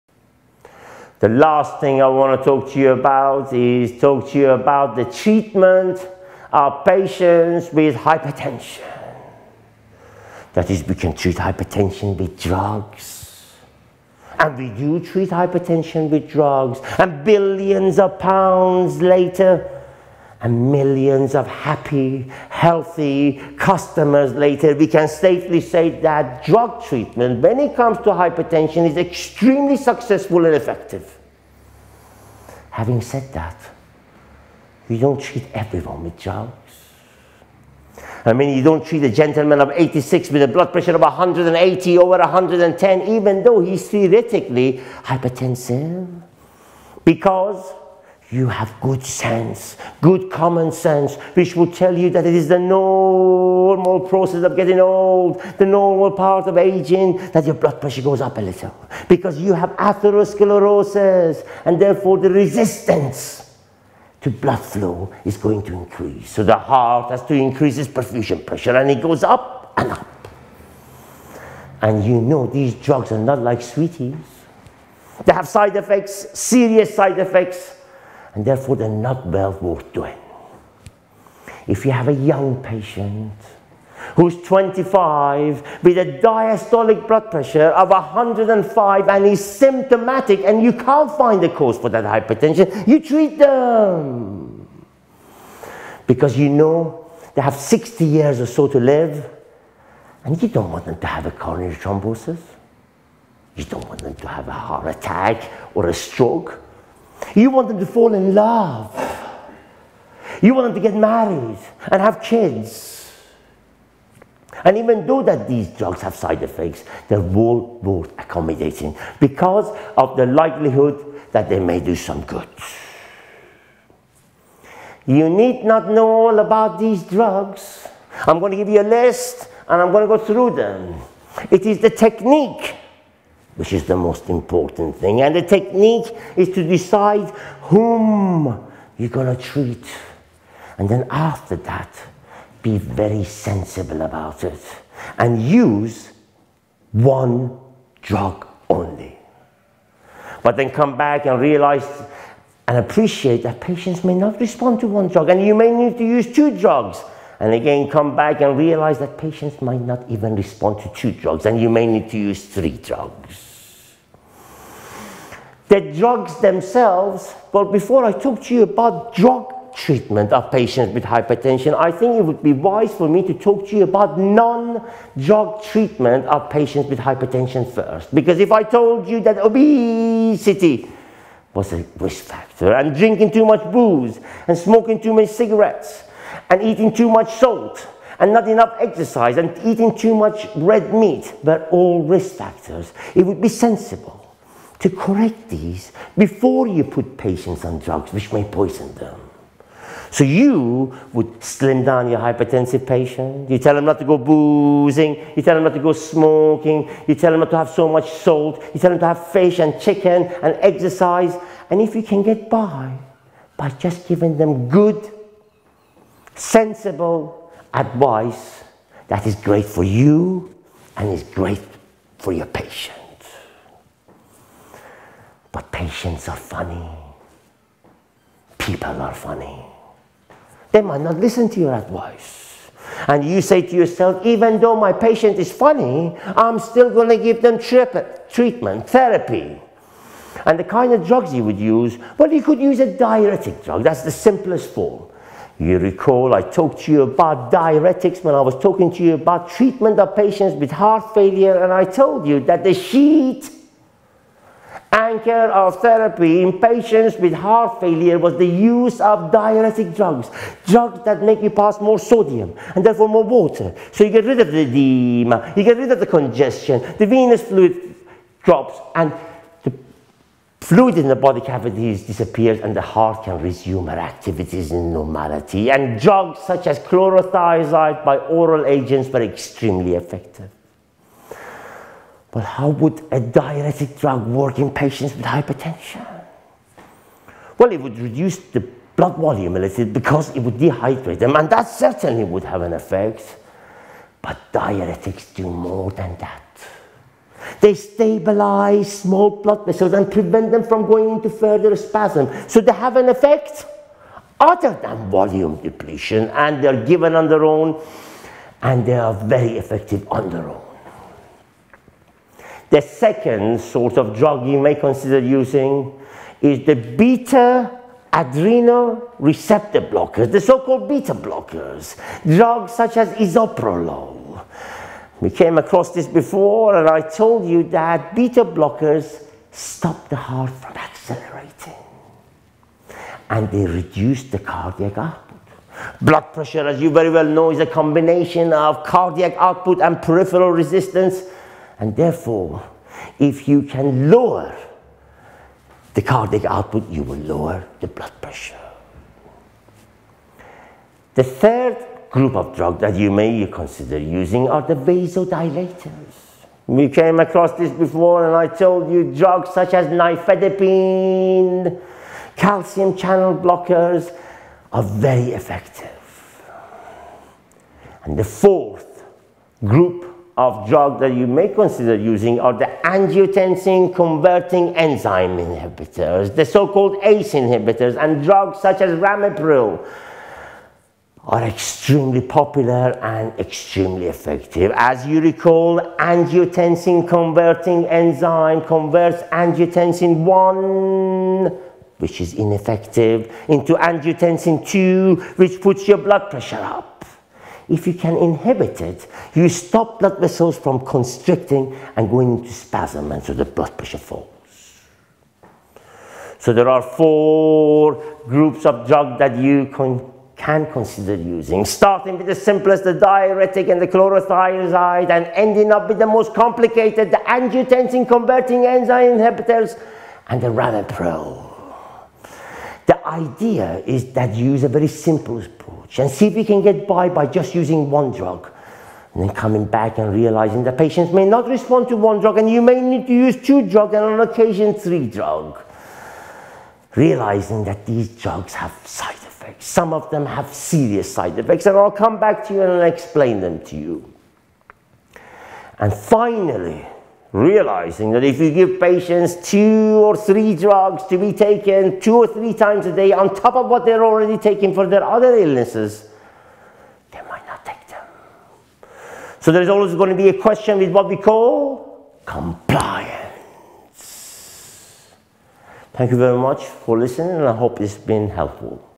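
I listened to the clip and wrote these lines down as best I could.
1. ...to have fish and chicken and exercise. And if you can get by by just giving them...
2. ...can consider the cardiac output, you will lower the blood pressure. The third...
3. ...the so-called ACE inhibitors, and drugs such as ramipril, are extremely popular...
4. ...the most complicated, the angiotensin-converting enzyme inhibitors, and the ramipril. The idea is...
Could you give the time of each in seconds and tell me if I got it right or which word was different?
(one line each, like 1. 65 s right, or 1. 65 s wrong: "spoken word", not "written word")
1. 208 s right
2. 343 s wrong: "lower", not "consider"
3. 376 s right
4. 415 s right.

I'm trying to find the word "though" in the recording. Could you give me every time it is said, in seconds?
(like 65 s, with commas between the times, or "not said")
43 s, 115 s, 234 s.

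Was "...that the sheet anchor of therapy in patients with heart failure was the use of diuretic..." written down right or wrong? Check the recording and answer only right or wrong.
right.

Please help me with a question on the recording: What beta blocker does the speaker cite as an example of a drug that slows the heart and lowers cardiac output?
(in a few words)
bisoprolol.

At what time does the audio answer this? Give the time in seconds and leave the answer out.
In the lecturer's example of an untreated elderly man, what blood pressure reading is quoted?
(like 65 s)
41 s.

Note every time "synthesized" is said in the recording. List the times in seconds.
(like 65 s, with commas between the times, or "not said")
not said.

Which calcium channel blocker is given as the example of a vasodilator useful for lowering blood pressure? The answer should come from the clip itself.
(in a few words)
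nifedipine.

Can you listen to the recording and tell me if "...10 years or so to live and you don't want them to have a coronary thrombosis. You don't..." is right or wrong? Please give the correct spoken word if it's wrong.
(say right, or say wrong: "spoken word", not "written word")
wrong: "60", not "10".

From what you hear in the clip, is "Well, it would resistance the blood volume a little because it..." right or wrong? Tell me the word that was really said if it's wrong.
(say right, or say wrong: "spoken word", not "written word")
wrong: "reduce", not "resistance".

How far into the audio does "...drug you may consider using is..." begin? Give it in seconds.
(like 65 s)
314 s.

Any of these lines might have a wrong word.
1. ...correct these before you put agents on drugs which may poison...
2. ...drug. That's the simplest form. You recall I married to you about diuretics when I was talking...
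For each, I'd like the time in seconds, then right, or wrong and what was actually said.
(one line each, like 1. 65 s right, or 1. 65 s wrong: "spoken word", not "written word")
1. 194 s wrong: "patients", not "agents"
2. 243 s wrong: "talked", not "married".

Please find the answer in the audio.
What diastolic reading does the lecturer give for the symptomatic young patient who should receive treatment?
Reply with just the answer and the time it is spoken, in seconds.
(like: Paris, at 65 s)
105, at 87 s.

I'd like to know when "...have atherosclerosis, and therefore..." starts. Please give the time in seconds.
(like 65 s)
59 s.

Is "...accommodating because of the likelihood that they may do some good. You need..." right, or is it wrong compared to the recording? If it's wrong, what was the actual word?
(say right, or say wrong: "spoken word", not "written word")
right.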